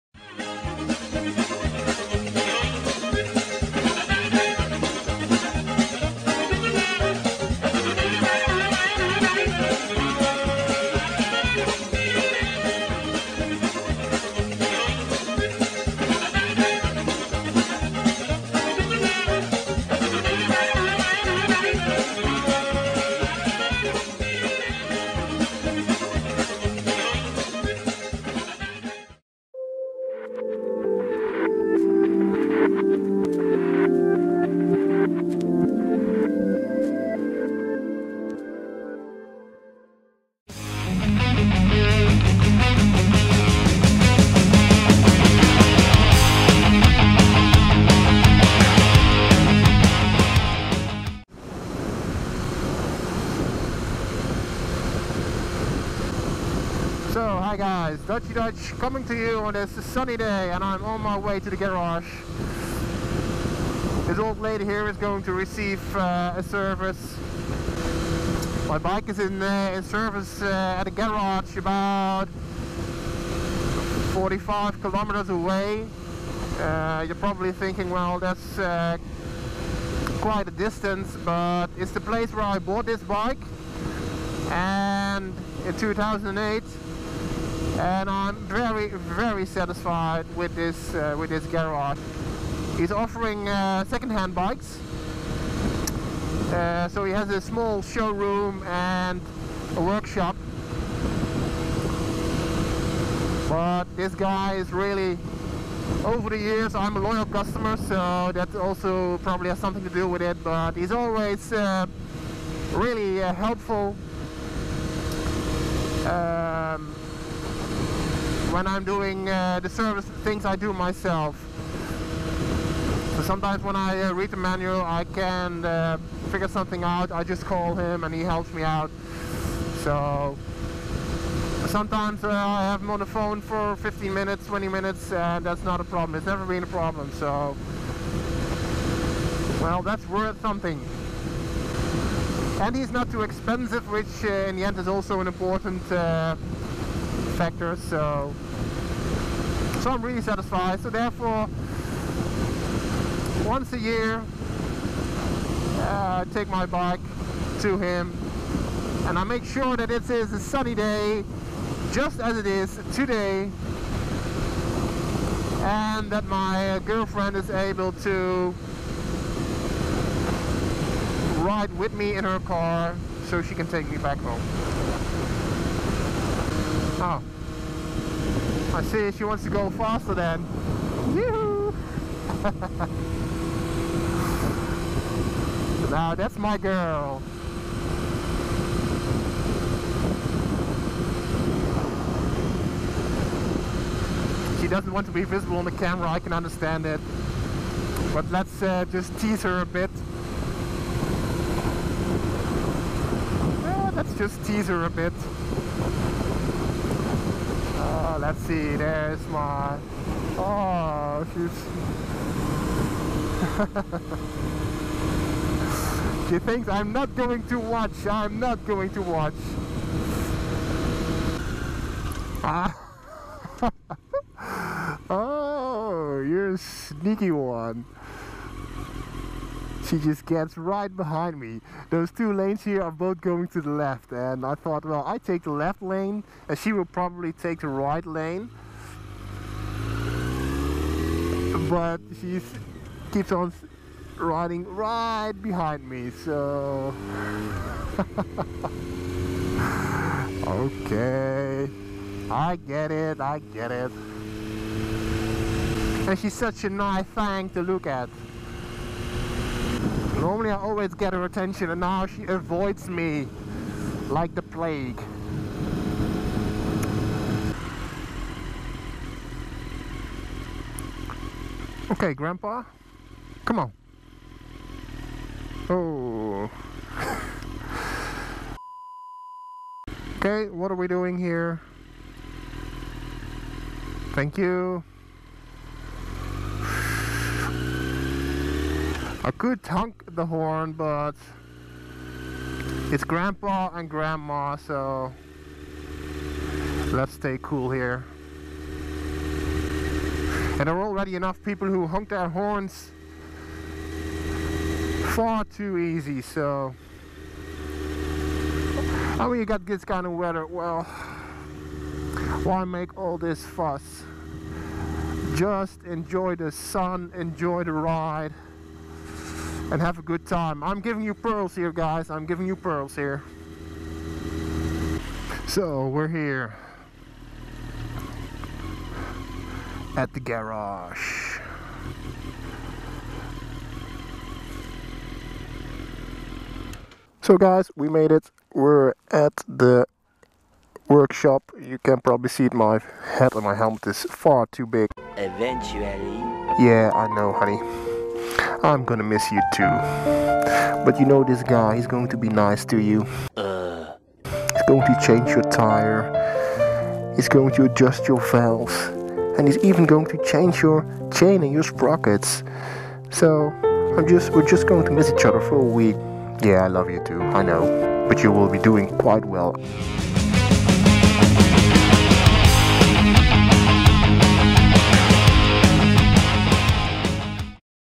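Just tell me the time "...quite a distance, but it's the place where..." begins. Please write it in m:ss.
1:20.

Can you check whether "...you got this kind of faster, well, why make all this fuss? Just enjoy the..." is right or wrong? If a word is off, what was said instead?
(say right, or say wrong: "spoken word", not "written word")
wrong: "weather", not "faster".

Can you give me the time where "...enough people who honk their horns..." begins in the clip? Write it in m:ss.
5:01.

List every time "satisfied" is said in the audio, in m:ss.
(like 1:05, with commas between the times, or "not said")
1:29, 2:30.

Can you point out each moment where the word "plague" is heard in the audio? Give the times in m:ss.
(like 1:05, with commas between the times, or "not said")
4:24.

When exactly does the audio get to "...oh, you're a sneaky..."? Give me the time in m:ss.
3:45.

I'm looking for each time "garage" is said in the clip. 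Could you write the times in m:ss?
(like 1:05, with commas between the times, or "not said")
1:01, 1:10, 1:31, 5:30.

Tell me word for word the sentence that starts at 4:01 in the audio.
But she keeps on riding right behind me, so...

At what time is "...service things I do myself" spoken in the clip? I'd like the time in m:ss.
1:59.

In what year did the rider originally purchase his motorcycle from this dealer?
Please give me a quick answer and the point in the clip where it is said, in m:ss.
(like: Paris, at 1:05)
2008, at 1:25.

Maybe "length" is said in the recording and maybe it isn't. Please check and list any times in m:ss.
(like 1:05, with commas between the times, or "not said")
not said.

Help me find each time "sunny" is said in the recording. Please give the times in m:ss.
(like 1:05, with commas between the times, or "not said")
0:59, 2:40.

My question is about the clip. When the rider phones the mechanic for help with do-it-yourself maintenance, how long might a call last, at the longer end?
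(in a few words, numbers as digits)
20 minutes.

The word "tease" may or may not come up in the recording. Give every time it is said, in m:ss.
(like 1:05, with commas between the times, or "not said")
3:19, 3:24.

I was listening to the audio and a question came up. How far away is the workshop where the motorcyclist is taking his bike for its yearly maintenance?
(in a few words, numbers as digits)
45 kilometers.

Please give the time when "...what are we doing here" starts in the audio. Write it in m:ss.
4:40.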